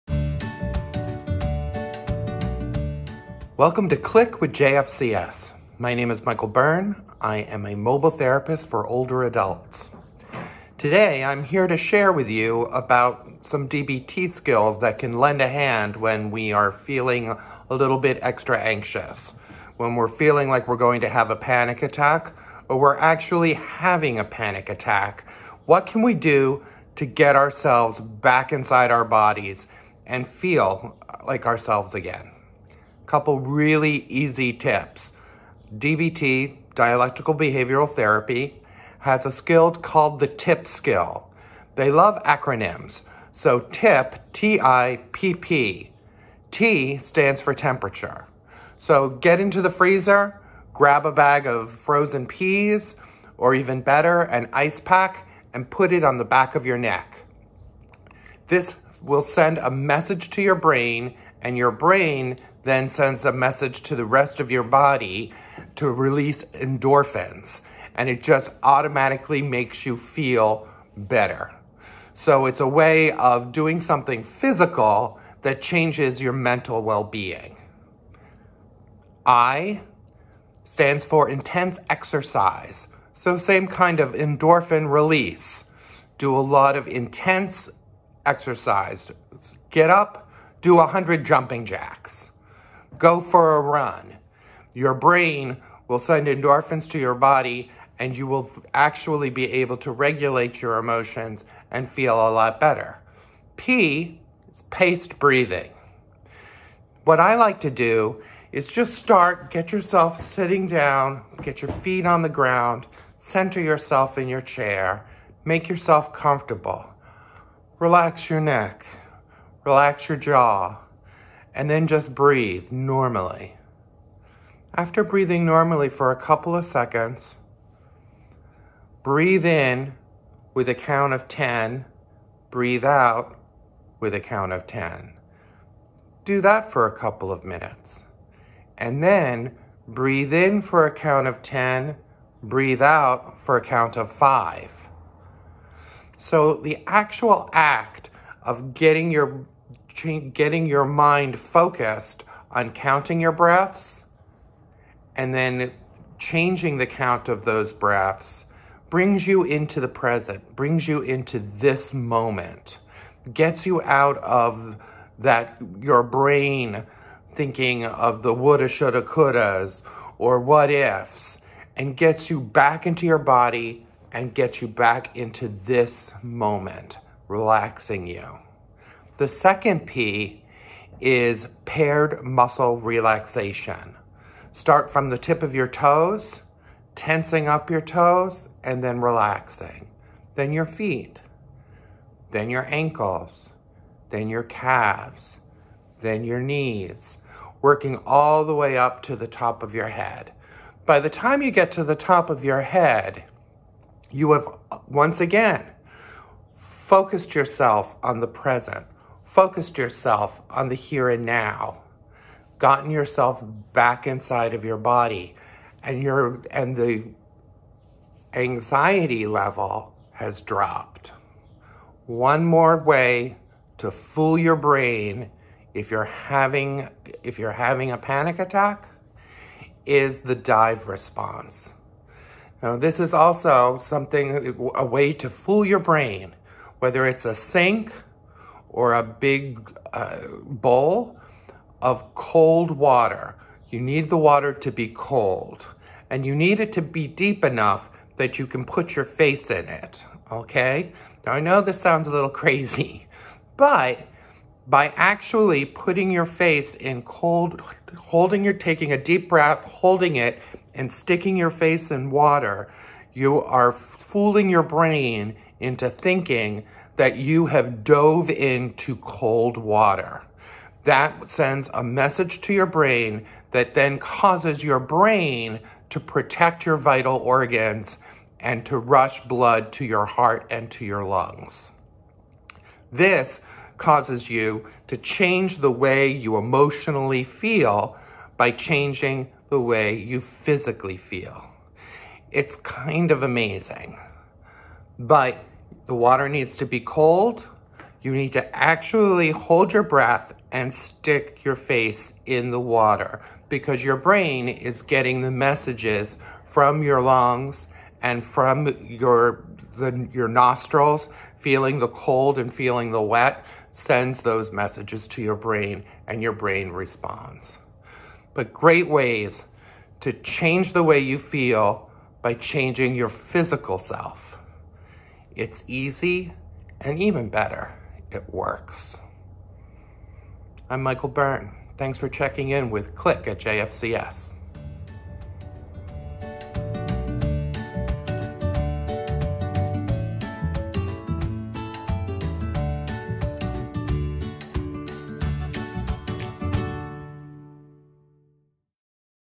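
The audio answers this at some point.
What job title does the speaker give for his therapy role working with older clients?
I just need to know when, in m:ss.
0:07.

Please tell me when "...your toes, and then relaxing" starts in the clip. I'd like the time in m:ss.
3:07.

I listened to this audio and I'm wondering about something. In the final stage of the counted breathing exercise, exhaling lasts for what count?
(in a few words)
5.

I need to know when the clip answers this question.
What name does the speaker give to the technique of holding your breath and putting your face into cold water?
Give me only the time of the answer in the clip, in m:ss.
3:50.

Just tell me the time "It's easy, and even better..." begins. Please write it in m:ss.
5:25.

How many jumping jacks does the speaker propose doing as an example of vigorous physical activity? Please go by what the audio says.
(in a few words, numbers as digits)
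100.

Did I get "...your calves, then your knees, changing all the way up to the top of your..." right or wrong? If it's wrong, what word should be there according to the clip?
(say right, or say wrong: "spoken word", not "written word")
wrong: "working", not "changing".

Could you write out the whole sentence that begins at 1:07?
And it just automatically makes you feel better.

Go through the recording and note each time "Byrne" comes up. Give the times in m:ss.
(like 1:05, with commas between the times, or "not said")
0:06, 5:31.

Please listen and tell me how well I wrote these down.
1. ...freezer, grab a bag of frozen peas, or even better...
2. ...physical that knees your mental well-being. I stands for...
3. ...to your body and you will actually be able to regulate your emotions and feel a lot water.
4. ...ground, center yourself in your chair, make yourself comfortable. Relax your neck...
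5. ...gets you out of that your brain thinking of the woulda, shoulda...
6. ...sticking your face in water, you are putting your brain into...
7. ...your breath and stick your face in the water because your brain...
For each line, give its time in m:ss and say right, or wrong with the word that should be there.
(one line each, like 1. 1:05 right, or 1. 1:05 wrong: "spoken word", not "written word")
1. 0:49 right
2. 1:14 wrong: "changes", not "knees"
3. 1:36 wrong: "better", not "water"
4. 1:52 right
5. 2:43 right
6. 4:20 wrong: "fooling", not "putting"
7. 4:59 right.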